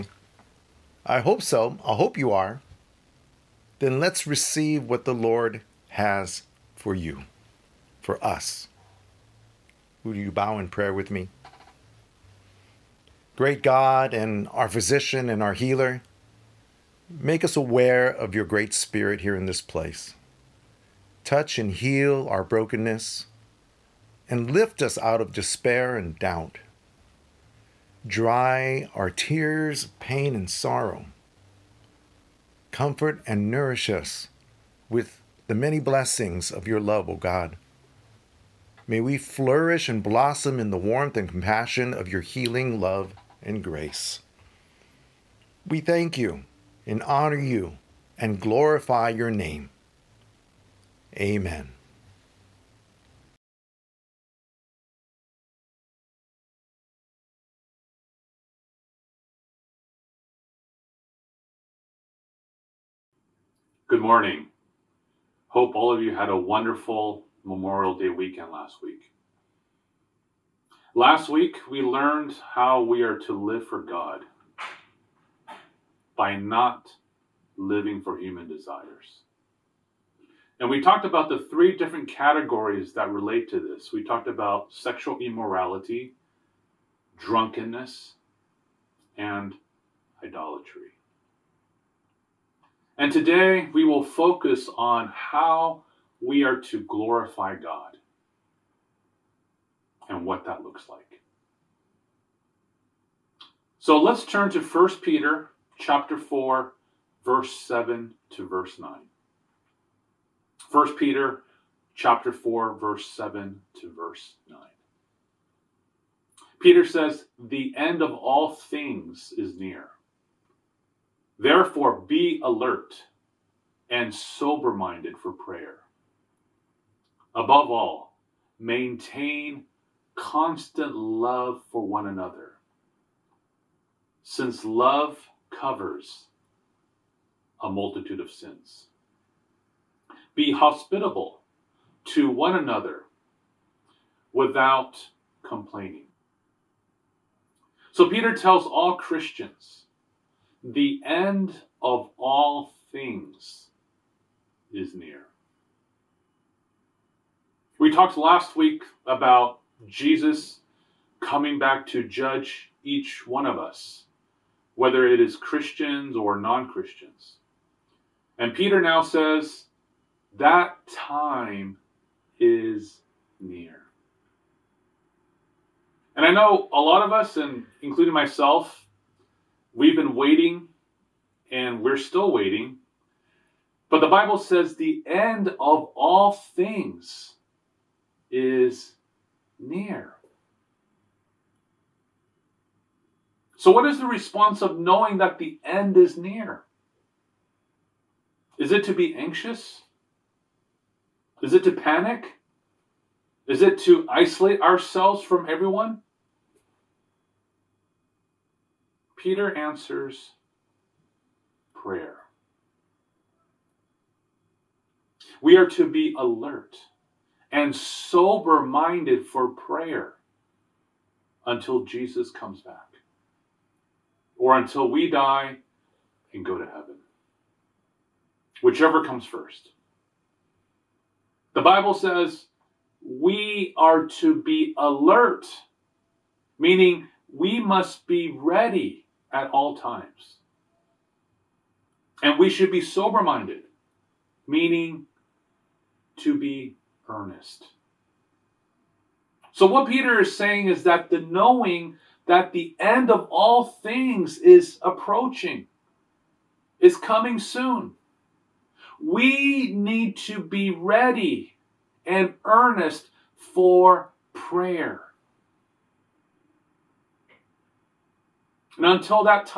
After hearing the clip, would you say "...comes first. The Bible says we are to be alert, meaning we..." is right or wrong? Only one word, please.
right.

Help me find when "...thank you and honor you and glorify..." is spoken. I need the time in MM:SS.
00:45.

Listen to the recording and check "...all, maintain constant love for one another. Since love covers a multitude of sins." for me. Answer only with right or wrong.
right.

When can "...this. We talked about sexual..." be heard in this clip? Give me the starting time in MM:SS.
01:23.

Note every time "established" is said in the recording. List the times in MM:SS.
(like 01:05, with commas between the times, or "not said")
not said.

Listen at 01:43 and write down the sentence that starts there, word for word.
So let's turn to 1 Peter chapter 4 verse 7 to verse 9.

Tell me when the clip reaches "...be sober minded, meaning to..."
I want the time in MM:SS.
04:02.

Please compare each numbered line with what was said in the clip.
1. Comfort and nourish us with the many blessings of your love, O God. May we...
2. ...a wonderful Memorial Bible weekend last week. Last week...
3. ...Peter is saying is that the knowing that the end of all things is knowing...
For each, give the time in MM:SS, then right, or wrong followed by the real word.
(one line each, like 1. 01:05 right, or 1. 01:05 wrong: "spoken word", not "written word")
1. 00:32 right
2. 01:06 wrong: "Day", not "Bible"
3. 04:09 wrong: "approaching", not "knowing".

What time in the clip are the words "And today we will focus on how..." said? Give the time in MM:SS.
01:32.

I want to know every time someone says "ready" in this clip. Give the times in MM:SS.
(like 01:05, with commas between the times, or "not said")
03:58, 04:20.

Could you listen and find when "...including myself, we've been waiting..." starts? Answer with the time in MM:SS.
02:57.